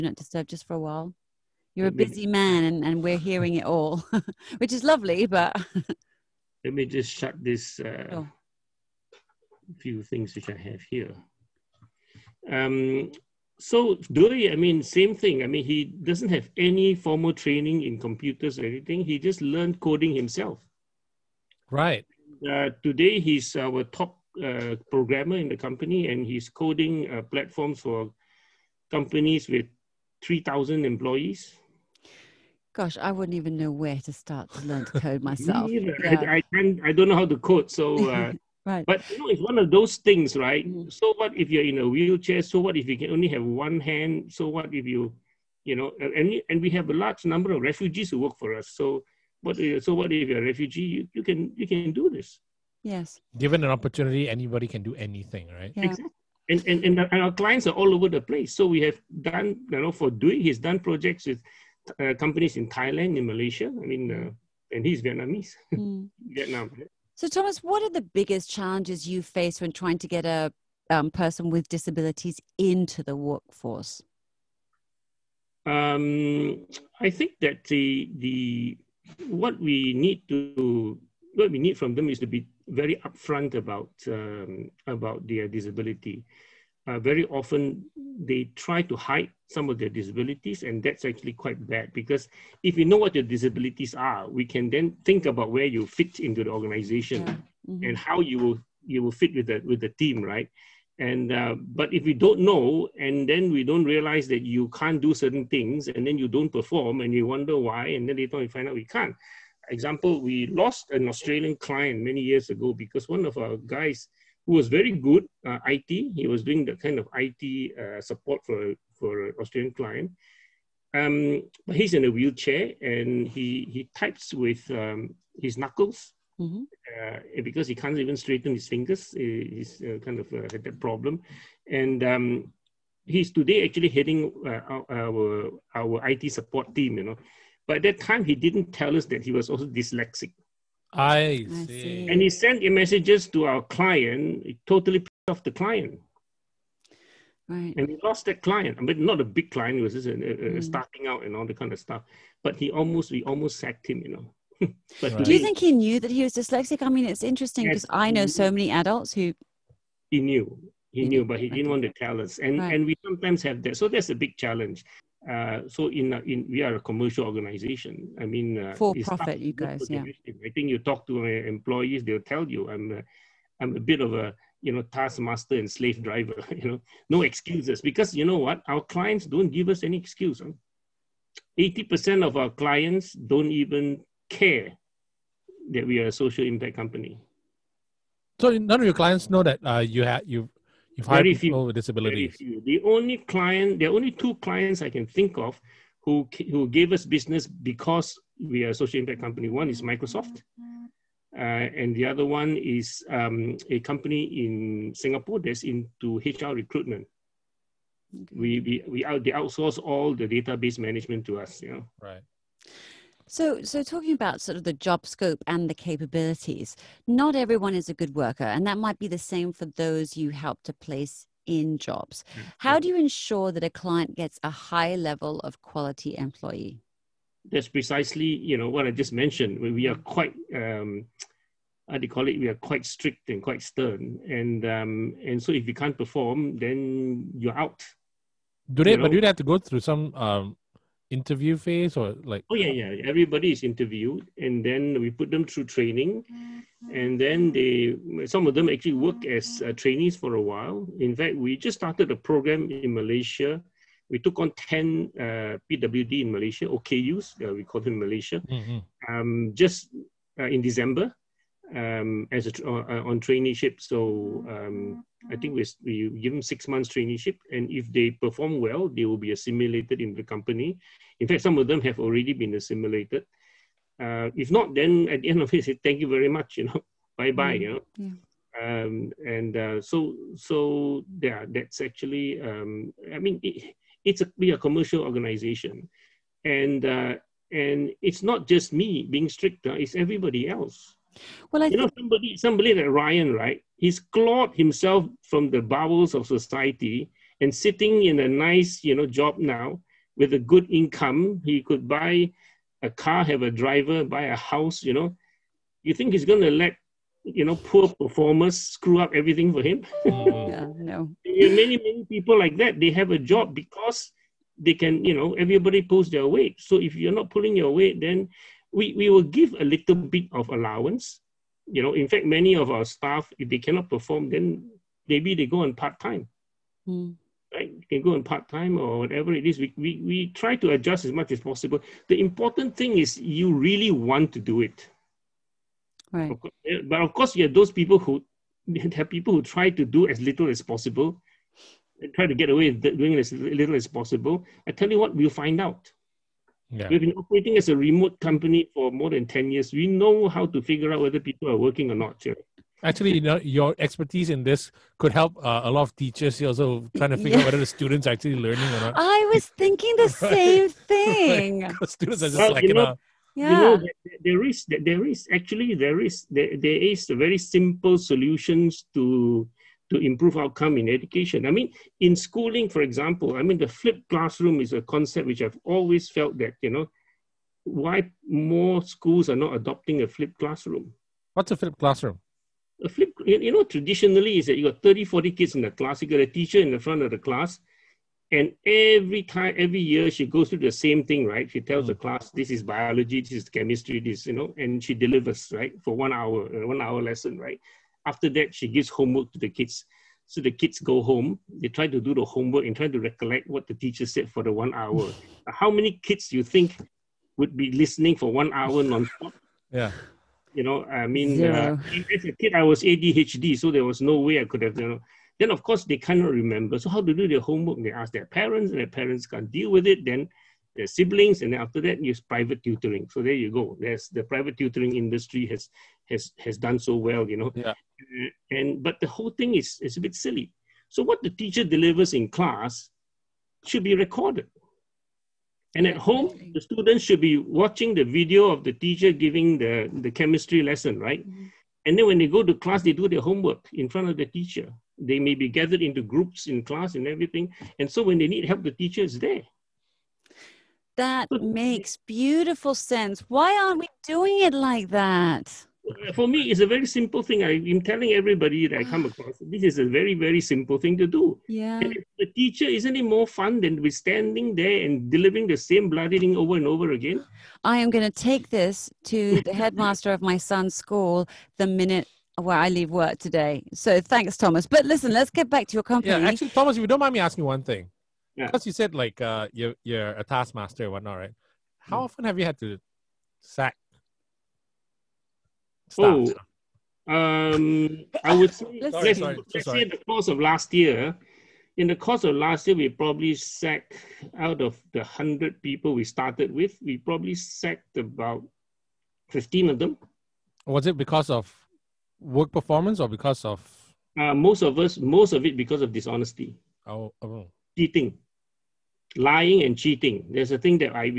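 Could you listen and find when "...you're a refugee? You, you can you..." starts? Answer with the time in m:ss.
0:50.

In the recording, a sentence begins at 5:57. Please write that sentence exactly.
out whether the students are actually learning or not.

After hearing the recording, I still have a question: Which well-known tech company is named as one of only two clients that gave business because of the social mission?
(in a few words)
Microsoft.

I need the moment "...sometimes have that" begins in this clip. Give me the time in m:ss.
2:43.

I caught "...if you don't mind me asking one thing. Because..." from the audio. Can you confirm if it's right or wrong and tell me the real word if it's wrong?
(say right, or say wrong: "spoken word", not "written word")
right.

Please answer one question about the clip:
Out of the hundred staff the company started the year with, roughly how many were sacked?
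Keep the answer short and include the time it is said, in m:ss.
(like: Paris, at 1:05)
15, at 8:19.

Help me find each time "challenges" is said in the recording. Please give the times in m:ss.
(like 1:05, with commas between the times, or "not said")
1:08, 2:44.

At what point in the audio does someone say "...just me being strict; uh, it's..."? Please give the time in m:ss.
4:48.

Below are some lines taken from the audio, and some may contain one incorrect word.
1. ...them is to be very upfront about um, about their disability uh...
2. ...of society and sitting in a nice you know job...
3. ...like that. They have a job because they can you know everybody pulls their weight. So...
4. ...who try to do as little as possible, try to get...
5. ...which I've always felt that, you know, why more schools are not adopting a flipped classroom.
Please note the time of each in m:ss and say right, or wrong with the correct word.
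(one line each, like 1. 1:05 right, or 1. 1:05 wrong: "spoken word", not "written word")
1. 1:21 right
2. 4:56 right
3. 5:12 right
4. 5:39 right
5. 6:15 right.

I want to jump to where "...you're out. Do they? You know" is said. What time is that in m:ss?
3:57.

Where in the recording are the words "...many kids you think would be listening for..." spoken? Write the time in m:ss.
6:45.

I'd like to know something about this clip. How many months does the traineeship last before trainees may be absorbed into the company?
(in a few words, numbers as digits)
6.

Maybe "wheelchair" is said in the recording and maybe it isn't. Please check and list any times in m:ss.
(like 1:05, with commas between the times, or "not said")
0:41, 2:02.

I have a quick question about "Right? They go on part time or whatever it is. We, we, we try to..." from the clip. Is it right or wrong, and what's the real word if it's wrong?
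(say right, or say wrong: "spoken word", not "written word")
right.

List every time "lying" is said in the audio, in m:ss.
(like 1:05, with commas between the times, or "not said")
8:29.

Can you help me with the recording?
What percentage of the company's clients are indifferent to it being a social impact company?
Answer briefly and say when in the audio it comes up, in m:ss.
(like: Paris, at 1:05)
80%, at 3:01.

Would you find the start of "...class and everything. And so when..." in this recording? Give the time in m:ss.
7:26.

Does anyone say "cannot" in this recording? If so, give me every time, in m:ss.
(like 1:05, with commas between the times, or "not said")
5:23, 6:55.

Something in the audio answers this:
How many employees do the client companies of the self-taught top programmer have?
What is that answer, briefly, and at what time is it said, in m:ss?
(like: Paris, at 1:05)
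3,000, at 0:30.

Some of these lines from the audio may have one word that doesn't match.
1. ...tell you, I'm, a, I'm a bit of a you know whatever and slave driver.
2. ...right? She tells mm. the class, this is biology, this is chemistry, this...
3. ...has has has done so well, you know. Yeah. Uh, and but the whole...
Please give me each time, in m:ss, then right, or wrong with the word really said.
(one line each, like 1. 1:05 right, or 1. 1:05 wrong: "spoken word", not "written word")
1. 2:52 wrong: "taskmaster", not "whatever"
2. 6:31 right
3. 7:05 right.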